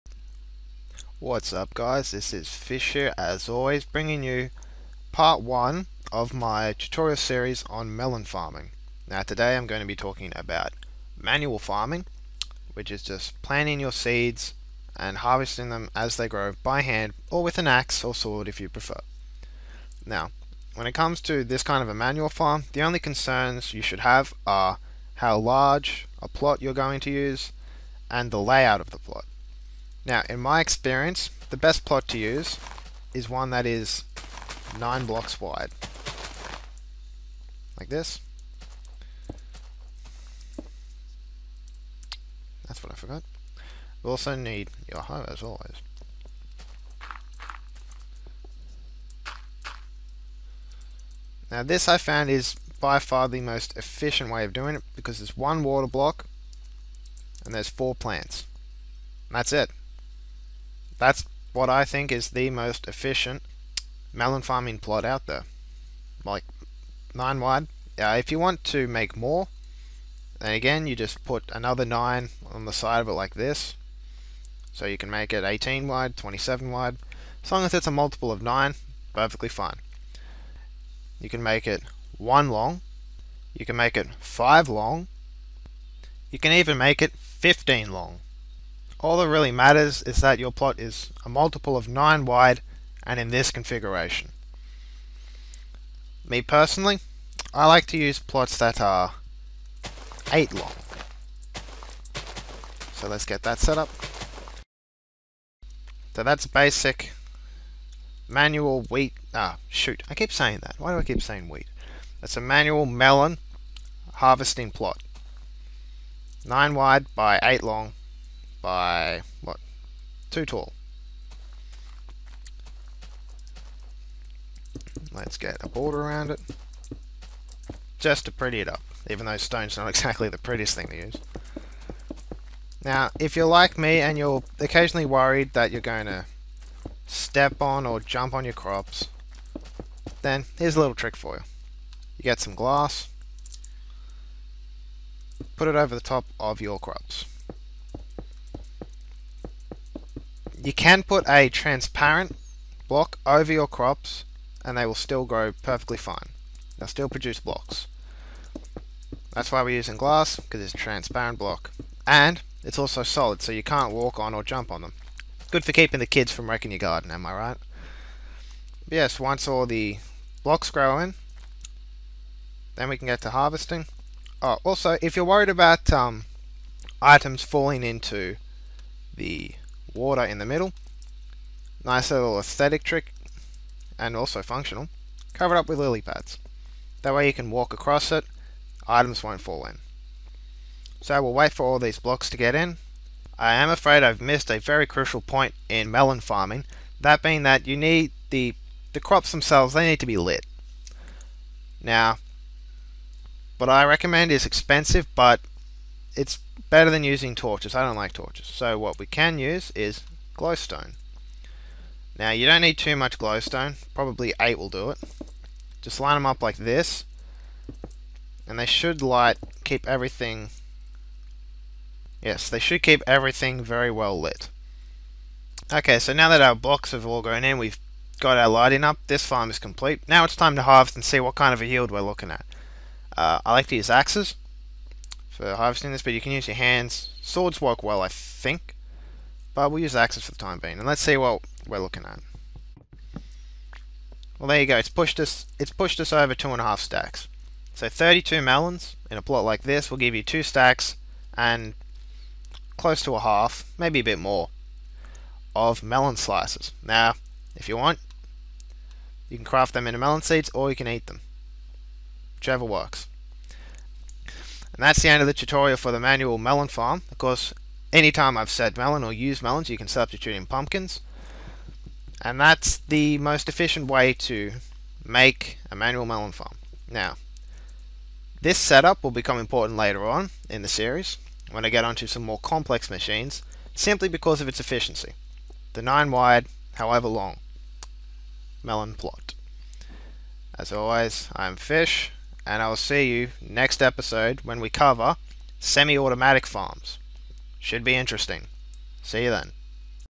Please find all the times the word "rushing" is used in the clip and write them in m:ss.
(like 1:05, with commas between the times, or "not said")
not said.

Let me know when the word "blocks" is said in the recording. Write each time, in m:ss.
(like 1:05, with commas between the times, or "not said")
0:35, 0:55, 2:32, 2:37, 2:41, 2:50, 3:11, 3:46.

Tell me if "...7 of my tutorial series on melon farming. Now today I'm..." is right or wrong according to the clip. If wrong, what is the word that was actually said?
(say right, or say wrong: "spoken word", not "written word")
wrong: "1", not "7".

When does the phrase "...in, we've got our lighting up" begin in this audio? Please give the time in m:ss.
3:47.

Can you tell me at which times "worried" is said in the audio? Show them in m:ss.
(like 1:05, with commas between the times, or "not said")
2:15, 2:55.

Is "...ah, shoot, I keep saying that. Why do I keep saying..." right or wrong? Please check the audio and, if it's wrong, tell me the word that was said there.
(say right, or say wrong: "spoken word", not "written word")
right.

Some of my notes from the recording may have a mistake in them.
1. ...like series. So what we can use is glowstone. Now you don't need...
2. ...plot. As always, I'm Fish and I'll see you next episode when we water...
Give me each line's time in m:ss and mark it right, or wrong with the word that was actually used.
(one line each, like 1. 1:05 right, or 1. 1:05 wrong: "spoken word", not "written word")
1. 3:27 wrong: "torches", not "series"
2. 4:48 wrong: "cover", not "water".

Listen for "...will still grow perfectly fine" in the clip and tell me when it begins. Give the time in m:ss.
2:34.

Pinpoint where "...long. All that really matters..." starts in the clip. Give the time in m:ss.
1:27.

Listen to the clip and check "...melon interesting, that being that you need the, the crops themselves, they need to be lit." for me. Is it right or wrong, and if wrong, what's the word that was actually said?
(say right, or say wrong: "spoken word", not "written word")
wrong: "farming", not "interesting".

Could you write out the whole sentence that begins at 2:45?
Good for keeping the kids from wrecking your garden, am I right?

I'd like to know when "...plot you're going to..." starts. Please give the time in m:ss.
0:26.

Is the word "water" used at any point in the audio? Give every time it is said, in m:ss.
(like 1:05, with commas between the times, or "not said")
0:55, 2:59.